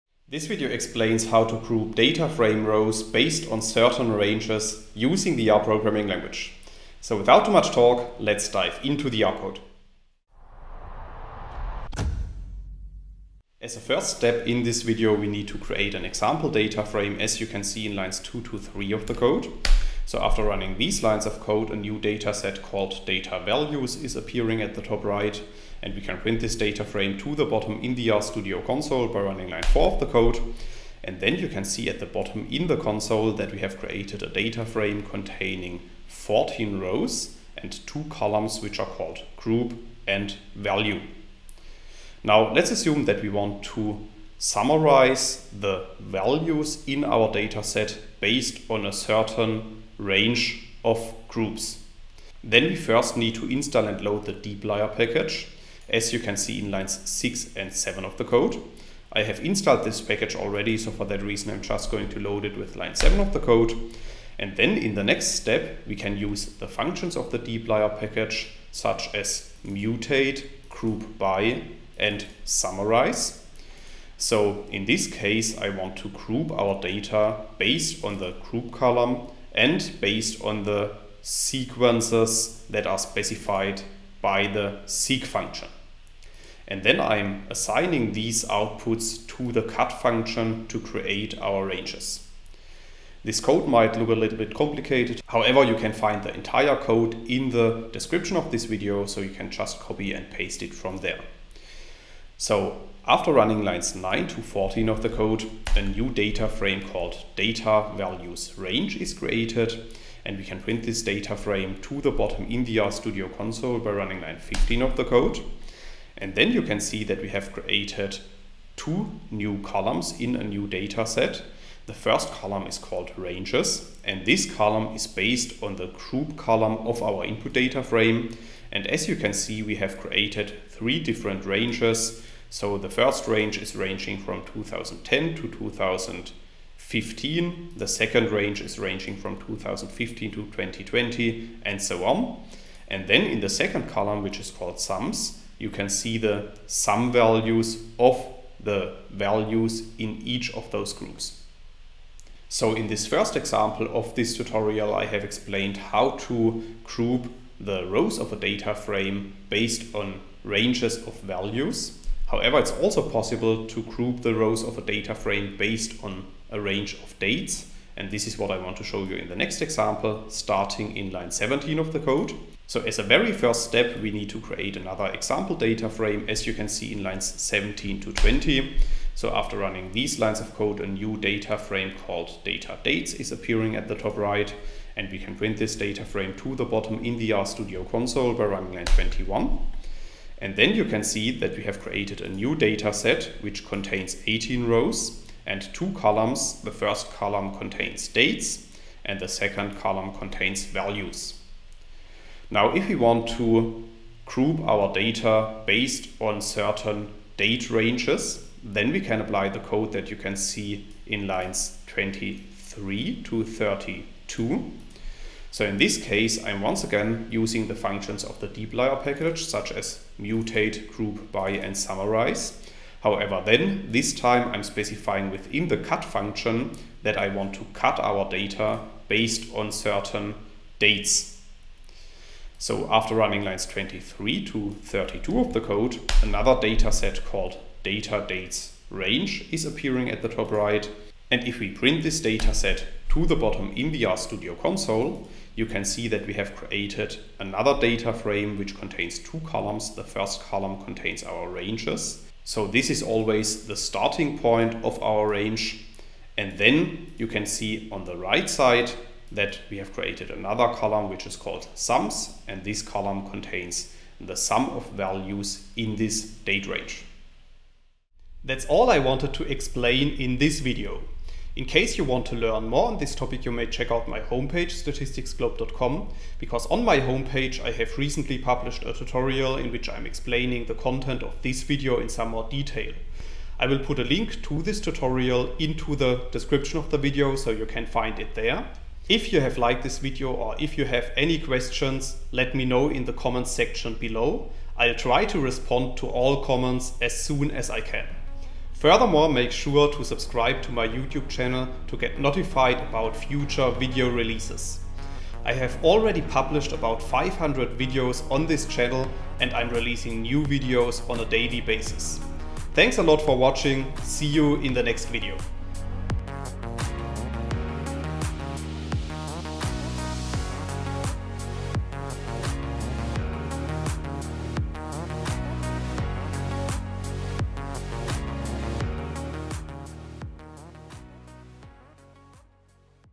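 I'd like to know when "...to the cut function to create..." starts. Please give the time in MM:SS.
01:29.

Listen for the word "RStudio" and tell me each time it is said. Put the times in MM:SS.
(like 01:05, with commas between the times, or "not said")
00:28, 01:52, 03:07, 04:04.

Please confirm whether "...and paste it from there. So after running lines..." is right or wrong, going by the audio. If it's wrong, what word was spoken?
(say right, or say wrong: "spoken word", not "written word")
right.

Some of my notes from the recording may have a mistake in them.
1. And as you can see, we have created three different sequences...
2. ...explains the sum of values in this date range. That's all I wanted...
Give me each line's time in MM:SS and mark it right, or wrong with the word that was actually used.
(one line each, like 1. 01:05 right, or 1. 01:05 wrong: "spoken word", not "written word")
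1. 02:08 wrong: "ranges", not "sequences"
2. 04:23 wrong: "contains", not "explains".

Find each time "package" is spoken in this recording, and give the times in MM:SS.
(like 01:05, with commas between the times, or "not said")
00:54, 01:00, 01:07, 03:39.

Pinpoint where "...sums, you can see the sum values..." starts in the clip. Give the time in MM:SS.
02:24.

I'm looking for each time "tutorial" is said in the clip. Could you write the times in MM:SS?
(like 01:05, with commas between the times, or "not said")
02:34, 04:38, 04:44.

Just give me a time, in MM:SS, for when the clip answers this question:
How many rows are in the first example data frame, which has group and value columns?
00:36.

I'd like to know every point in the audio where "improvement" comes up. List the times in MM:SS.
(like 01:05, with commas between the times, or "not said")
not said.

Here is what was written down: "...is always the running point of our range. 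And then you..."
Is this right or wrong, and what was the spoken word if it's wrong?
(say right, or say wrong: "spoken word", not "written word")
wrong: "starting", not "running".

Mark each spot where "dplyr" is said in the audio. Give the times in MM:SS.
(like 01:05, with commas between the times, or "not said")
00:54, 01:07, 03:38.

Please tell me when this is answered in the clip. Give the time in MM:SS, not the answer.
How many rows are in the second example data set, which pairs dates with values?
03:14.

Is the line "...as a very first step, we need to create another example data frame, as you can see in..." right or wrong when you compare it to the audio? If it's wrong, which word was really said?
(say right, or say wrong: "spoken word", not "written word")
right.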